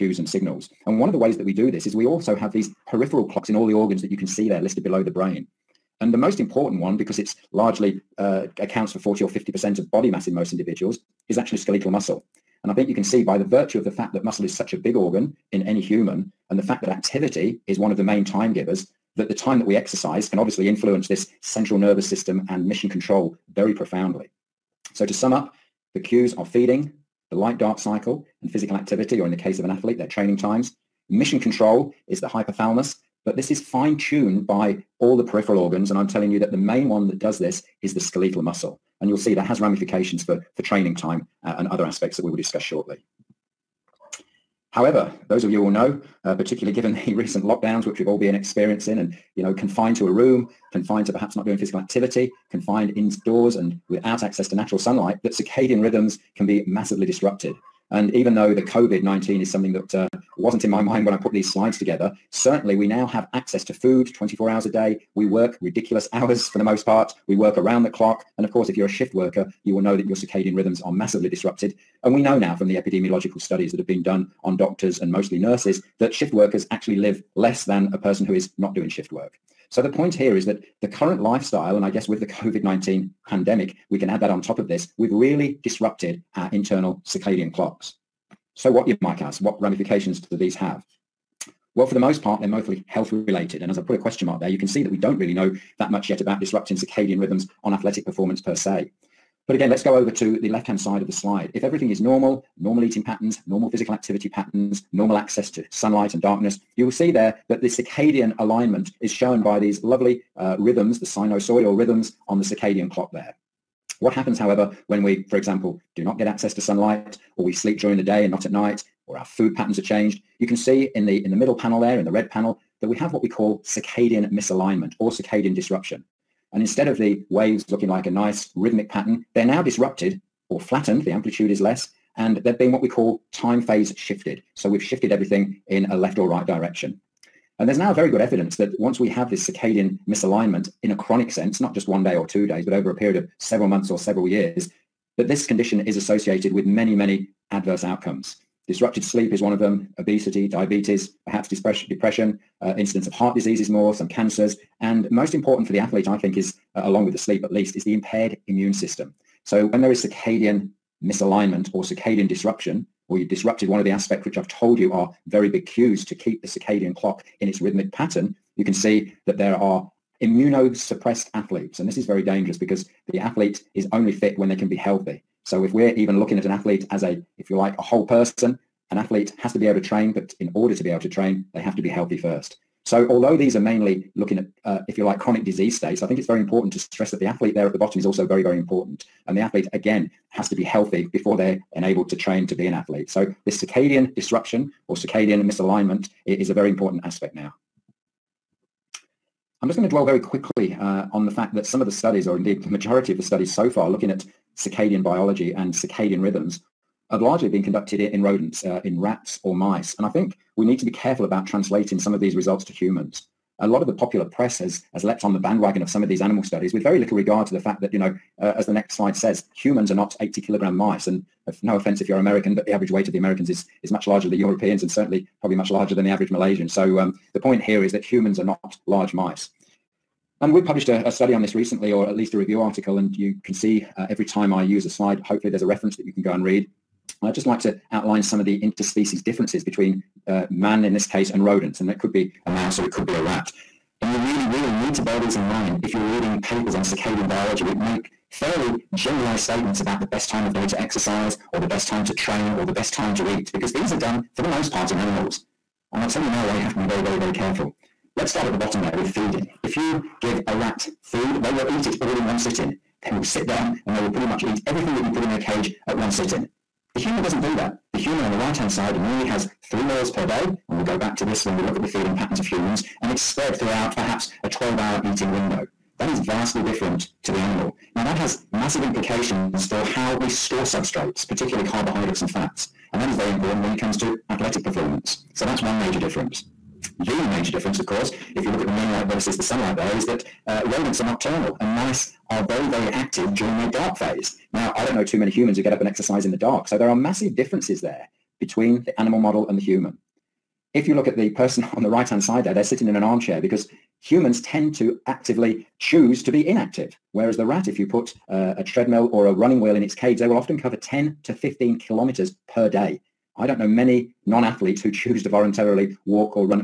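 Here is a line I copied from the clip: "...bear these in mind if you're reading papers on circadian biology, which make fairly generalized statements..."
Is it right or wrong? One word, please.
right.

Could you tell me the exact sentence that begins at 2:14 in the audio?
So we've shifted everything in a left or right direction.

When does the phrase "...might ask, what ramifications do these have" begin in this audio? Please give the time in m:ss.
1:29.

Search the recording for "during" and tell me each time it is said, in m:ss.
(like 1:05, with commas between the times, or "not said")
1:57, 4:53.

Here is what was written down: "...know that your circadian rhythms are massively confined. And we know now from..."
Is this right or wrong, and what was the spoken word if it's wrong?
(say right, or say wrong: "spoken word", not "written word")
wrong: "disrupted", not "confined".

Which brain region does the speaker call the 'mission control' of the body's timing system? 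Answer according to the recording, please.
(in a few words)
Hypothalamus.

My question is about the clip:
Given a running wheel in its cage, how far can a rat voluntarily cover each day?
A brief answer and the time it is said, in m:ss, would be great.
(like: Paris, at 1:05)
10 to 15 kilometers, at 5:10.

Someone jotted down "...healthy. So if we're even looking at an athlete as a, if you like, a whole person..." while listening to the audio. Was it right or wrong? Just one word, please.
right.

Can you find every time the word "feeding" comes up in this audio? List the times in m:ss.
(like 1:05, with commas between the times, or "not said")
0:26, 4:19, 4:31.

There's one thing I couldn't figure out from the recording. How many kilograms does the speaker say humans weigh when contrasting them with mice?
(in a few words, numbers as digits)
80 kilograms.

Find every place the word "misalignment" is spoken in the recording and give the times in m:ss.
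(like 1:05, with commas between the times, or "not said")
2:04, 2:20, 2:41, 3:15.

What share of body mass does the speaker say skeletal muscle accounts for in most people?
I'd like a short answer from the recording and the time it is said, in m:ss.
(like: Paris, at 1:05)
40 or 50%, at 0:08.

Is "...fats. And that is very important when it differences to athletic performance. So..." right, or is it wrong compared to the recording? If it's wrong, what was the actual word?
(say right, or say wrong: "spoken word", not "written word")
wrong: "comes", not "differences".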